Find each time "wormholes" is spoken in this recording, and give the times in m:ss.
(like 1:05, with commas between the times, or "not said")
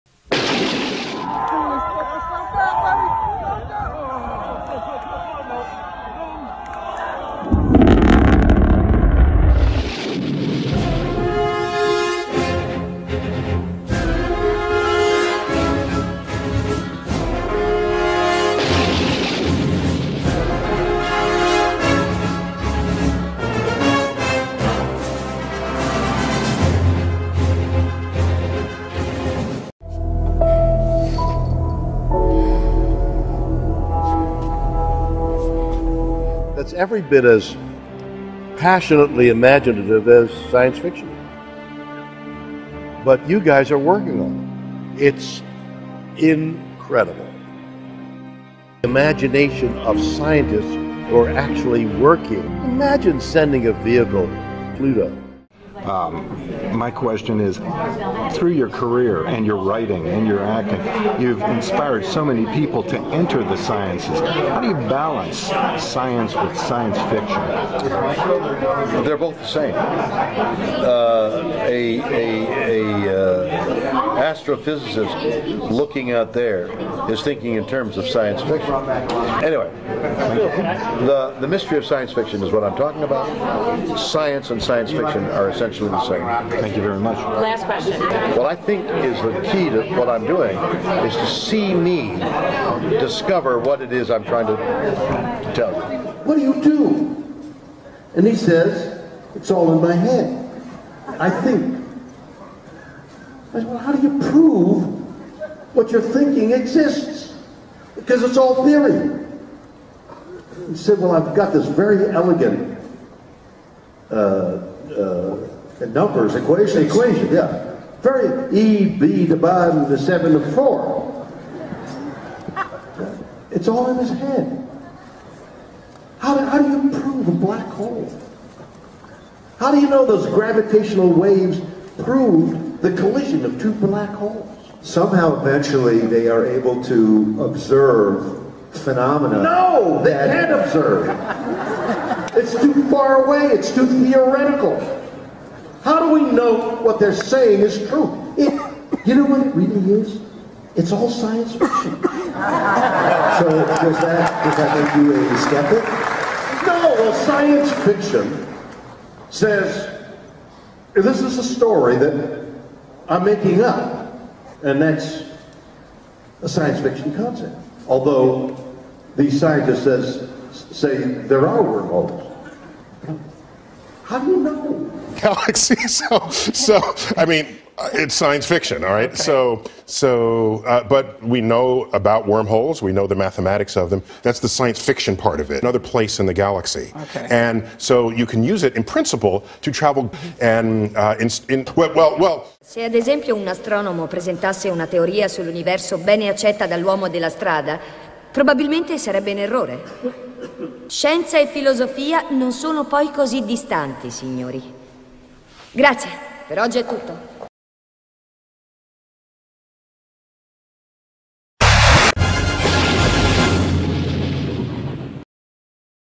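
2:51, 3:02.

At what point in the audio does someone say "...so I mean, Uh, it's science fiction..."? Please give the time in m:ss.
2:56.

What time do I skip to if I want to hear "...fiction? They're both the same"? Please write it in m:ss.
1:07.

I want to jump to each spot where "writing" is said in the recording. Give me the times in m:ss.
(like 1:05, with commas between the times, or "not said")
0:59.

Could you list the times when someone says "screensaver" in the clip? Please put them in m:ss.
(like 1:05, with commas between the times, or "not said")
not said.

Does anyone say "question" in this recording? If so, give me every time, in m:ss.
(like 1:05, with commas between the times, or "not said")
0:56, 1:27.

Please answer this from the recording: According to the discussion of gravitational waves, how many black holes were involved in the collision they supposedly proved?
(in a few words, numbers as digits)
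2.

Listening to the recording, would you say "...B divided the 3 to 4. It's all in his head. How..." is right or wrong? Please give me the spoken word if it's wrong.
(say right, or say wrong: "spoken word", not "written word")
wrong: "7", not "3".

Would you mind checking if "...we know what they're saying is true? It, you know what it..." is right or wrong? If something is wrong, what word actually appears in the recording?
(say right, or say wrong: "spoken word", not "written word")
right.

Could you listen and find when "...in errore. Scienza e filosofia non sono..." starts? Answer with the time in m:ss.
3:19.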